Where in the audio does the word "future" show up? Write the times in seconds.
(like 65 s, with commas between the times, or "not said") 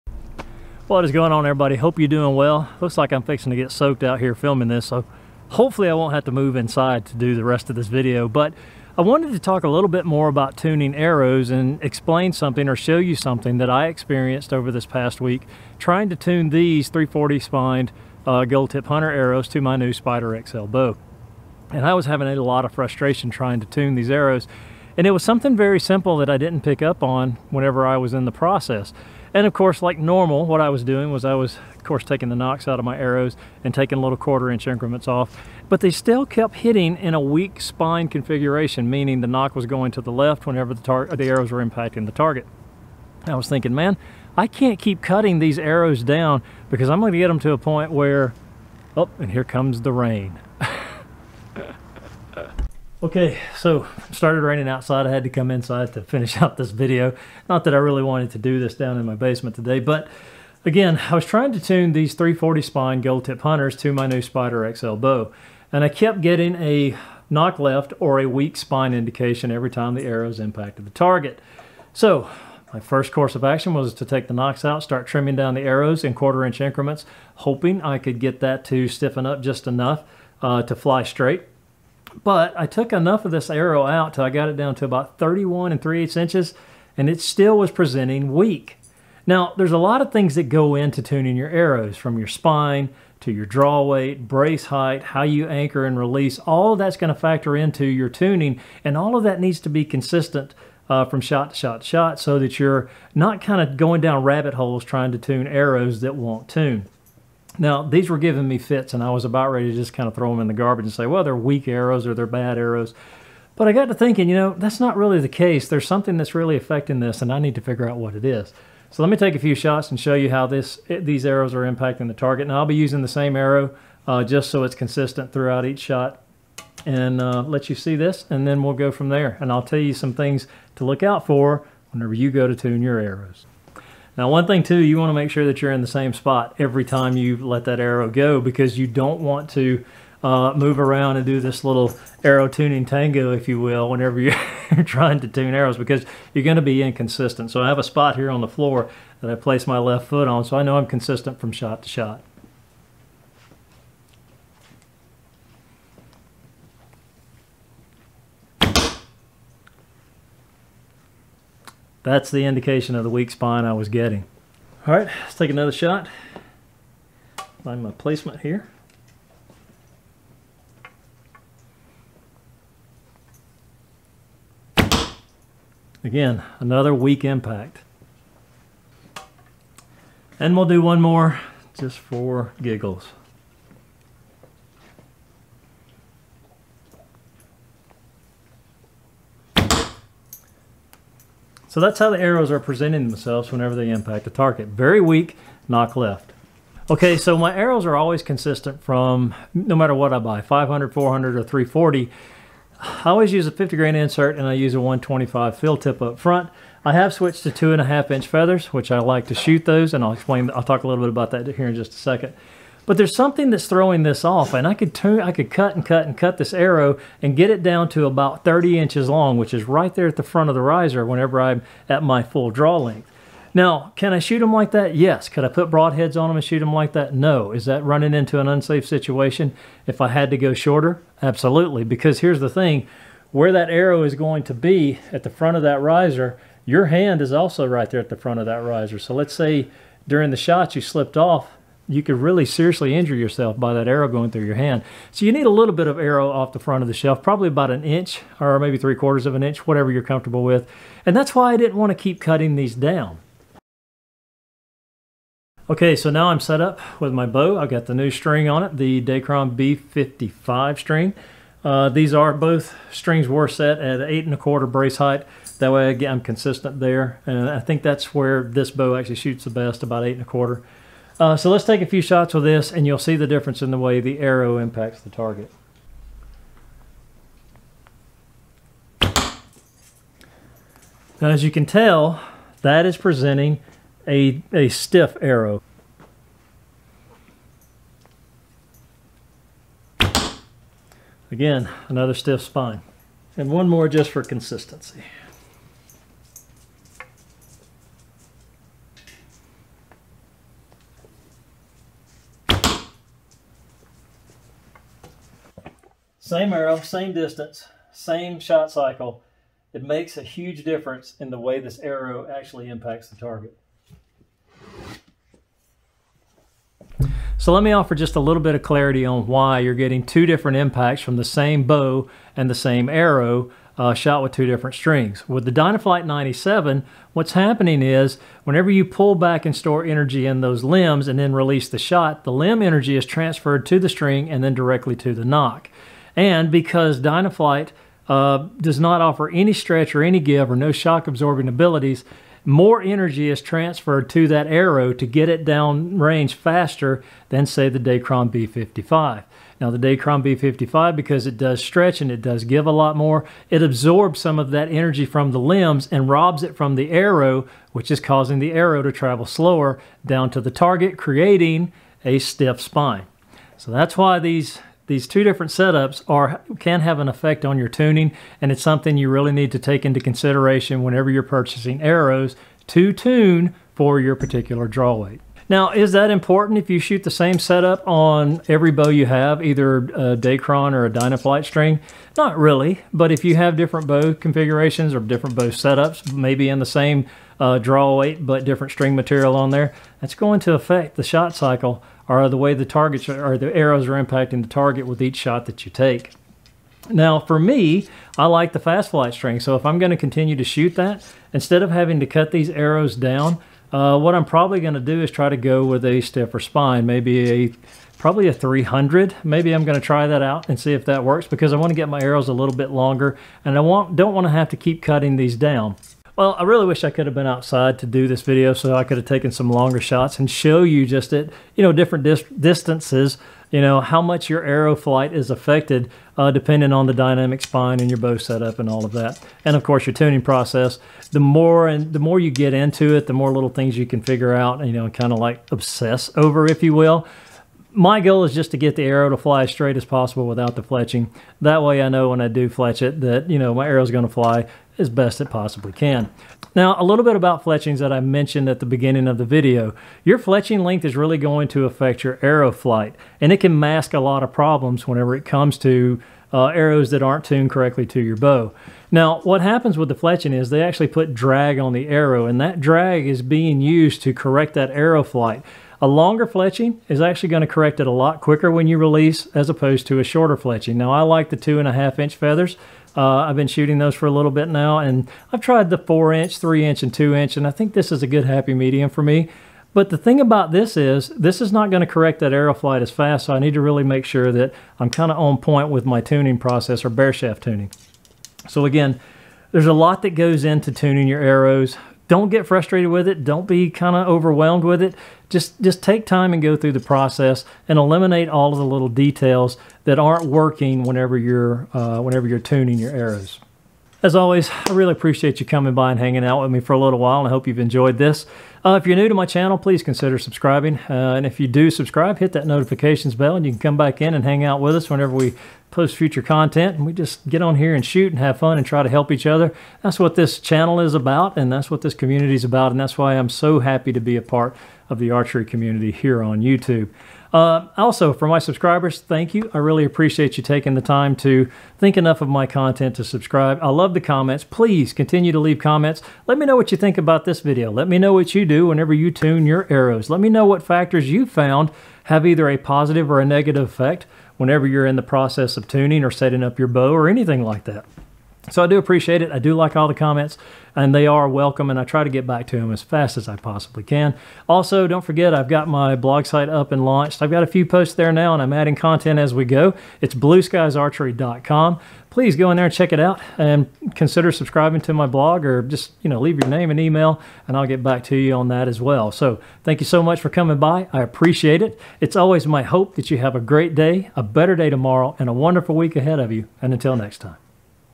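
515 s.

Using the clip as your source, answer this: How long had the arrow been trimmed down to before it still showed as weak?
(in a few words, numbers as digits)
31 3/8 inches.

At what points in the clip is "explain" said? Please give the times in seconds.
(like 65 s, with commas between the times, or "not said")
11 s, 210 s.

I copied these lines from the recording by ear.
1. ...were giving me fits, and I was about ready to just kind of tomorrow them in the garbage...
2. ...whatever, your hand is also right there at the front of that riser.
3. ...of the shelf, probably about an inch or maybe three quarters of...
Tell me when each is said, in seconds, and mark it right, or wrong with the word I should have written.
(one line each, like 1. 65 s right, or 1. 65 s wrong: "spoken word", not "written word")
1. 108 s wrong: "throw", not "tomorrow"
2. 235 s wrong: "riser", not "whatever"
3. 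246 s right.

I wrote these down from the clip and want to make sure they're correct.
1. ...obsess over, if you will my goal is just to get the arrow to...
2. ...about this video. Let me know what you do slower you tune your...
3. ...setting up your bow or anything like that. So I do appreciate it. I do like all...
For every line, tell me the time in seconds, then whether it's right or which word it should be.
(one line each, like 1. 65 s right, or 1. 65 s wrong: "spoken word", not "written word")
1. 435 s right
2. 536 s wrong: "whenever", not "slower"
3. 546 s right.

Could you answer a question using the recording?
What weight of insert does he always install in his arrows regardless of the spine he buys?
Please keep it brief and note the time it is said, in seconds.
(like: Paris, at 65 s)
50 grain, at 203 s.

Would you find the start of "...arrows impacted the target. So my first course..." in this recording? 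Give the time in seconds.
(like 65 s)
70 s.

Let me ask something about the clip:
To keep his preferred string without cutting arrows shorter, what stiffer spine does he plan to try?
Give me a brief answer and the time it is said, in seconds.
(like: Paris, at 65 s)
300, at 408 s.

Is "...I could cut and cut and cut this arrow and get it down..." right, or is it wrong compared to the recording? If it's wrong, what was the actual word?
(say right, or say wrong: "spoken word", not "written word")
right.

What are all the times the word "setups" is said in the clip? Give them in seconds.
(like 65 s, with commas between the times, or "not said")
365 s, 377 s, 385 s, 428 s.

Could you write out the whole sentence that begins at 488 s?
So again, there's a lot that goes into tuning your arrows don't get frustrated with it.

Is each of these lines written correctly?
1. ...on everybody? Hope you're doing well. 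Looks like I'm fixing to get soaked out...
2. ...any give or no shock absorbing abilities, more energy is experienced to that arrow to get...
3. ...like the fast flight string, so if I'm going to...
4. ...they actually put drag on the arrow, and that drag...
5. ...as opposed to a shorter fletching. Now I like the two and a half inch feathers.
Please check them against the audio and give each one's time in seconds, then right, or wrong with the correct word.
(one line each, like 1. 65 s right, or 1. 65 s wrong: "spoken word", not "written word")
1. 1 s right
2. 340 s wrong: "transferred", not "experienced"
3. 398 s right
4. 460 s right
5. 469 s right.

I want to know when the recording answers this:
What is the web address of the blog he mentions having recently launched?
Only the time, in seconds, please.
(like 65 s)
560 s.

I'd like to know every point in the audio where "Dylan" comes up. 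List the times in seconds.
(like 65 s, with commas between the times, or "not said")
not said.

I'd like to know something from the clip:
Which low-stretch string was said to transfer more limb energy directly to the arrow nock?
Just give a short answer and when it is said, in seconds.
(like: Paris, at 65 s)
Dynaflight 97, at 325 s.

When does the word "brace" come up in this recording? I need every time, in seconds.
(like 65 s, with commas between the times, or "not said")
94 s, 264 s.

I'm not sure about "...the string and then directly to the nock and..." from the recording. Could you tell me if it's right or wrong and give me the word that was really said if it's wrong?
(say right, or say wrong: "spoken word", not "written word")
right.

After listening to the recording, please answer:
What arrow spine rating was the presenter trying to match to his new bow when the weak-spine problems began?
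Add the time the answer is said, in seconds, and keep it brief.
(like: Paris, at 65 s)
340, at 16 s.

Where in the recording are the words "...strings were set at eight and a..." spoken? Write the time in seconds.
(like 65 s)
262 s.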